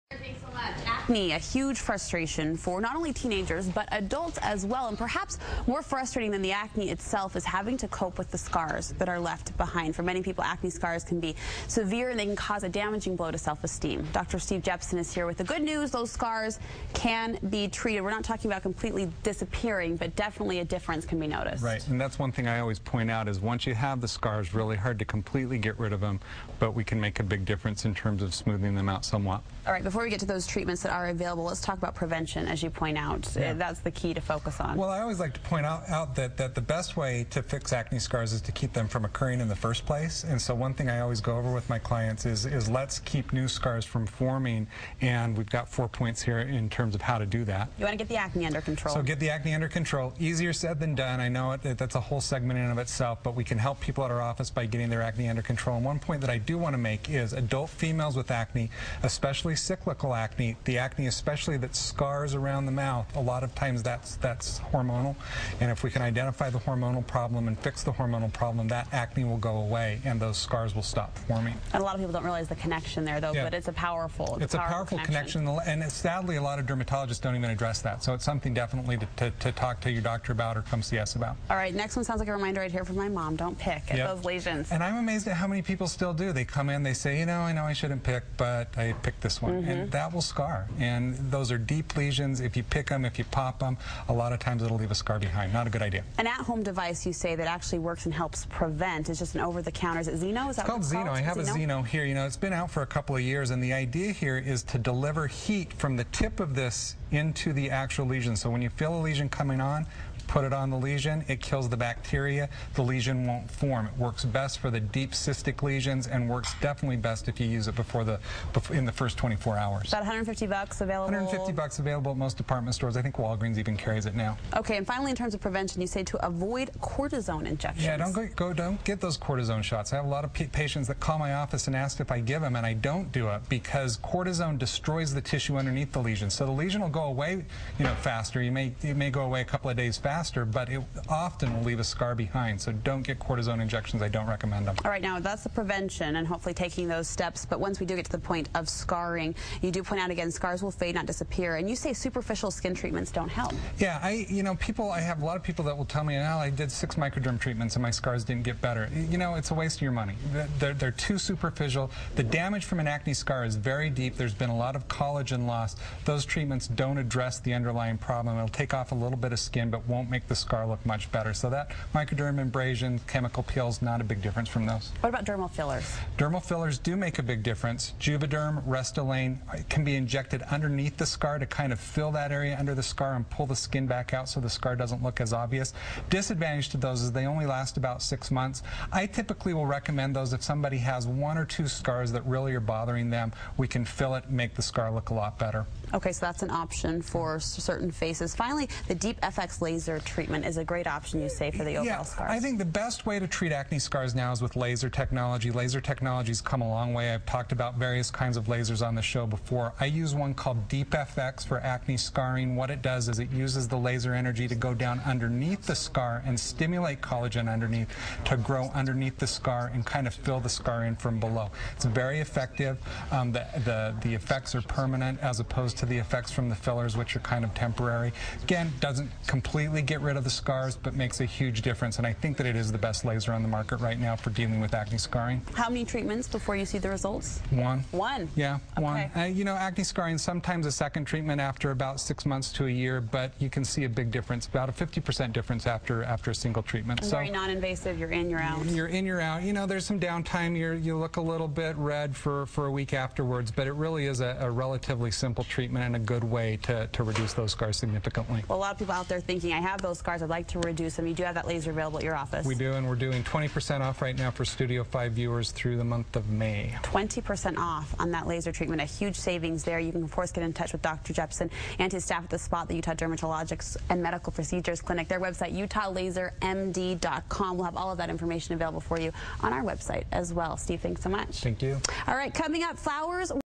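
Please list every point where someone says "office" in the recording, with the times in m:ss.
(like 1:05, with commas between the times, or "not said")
0:54, 2:11, 4:22.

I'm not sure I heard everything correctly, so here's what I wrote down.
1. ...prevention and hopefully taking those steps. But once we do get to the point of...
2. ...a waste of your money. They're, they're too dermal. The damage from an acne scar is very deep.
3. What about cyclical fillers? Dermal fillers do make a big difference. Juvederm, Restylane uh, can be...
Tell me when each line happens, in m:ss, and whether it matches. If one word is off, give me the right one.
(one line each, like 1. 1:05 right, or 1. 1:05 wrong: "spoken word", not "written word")
1. 2:25 right
2. 2:39 wrong: "superficial", not "dermal"
3. 2:54 wrong: "dermal", not "cyclical".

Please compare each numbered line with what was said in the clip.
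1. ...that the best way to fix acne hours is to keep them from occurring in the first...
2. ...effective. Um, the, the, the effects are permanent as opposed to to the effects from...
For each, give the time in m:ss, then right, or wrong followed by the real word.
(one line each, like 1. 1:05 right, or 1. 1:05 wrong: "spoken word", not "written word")
1. 0:36 wrong: "scars", not "hours"
2. 3:42 right.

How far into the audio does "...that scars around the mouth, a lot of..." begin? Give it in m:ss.
1:01.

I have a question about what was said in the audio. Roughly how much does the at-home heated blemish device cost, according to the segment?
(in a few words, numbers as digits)
$150.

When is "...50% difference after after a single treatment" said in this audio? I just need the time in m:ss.
4:04.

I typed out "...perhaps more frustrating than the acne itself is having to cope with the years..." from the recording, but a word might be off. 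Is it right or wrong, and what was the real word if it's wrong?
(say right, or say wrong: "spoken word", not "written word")
wrong: "scars", not "years".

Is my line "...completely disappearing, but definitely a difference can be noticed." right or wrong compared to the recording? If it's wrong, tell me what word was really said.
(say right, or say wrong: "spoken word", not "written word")
right.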